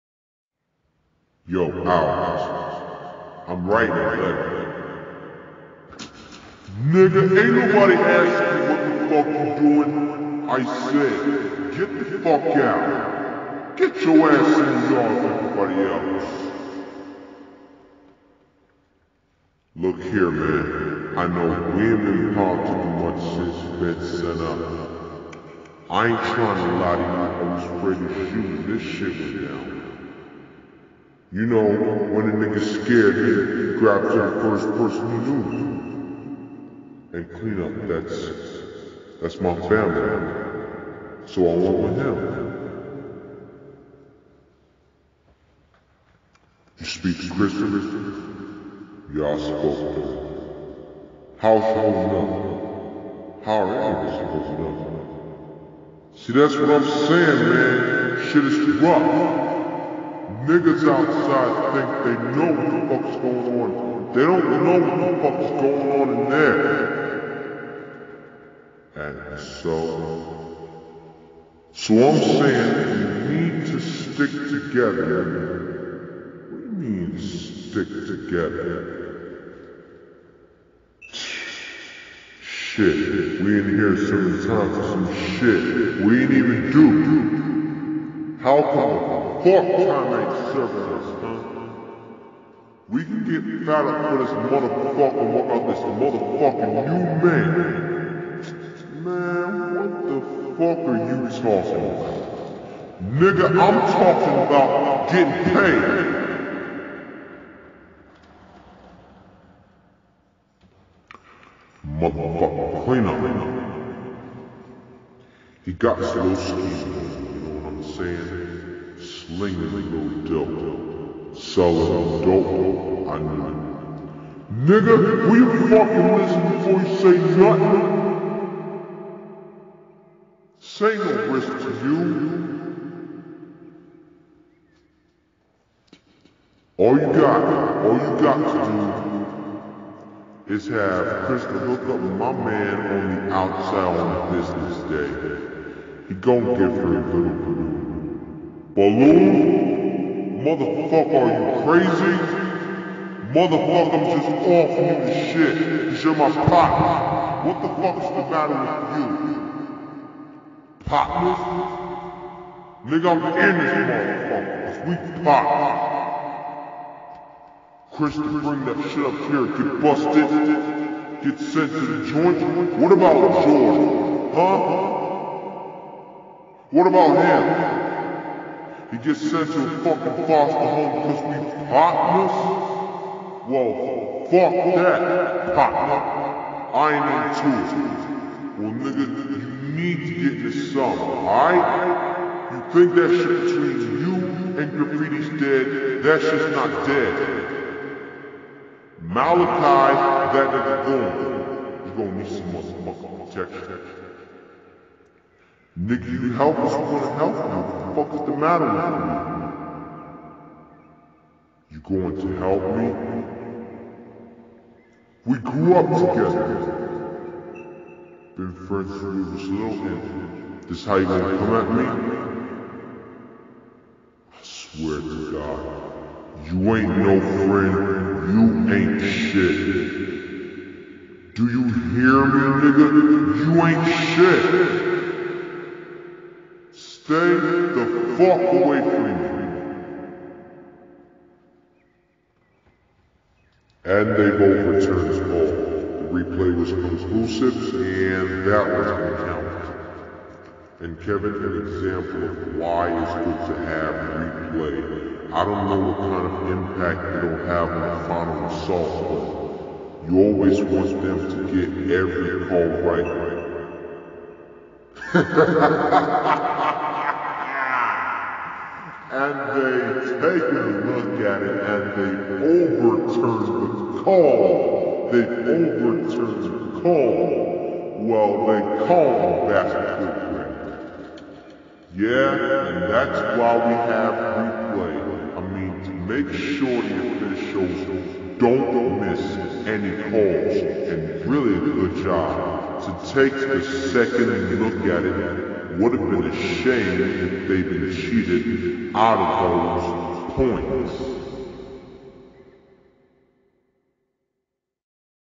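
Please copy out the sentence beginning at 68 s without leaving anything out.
And so, so I'm saying we need to stick together.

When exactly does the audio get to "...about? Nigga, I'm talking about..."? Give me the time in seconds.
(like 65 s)
101 s.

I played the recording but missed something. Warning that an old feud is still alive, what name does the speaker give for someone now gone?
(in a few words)
Malachi.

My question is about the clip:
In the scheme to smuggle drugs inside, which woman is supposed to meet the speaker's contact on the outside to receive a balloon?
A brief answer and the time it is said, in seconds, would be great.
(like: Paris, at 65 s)
Crystal, at 141 s.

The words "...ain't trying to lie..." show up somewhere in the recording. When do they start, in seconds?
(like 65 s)
26 s.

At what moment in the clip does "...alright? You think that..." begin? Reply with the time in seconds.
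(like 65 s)
190 s.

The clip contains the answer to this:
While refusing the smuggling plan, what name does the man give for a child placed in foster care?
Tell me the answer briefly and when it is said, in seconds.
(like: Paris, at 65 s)
George, at 173 s.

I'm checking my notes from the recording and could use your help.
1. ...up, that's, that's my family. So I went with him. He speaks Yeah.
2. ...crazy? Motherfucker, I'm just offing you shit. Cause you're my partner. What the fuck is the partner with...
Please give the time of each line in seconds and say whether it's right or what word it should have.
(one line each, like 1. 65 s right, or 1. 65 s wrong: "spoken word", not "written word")
1. 37 s wrong: "Christian", not "Yeah"
2. 151 s wrong: "matter", not "partner".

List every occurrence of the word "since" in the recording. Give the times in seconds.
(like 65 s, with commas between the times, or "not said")
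23 s, 218 s.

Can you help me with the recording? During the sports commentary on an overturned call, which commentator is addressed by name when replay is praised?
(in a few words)
Kevin.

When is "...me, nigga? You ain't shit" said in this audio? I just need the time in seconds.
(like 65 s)
232 s.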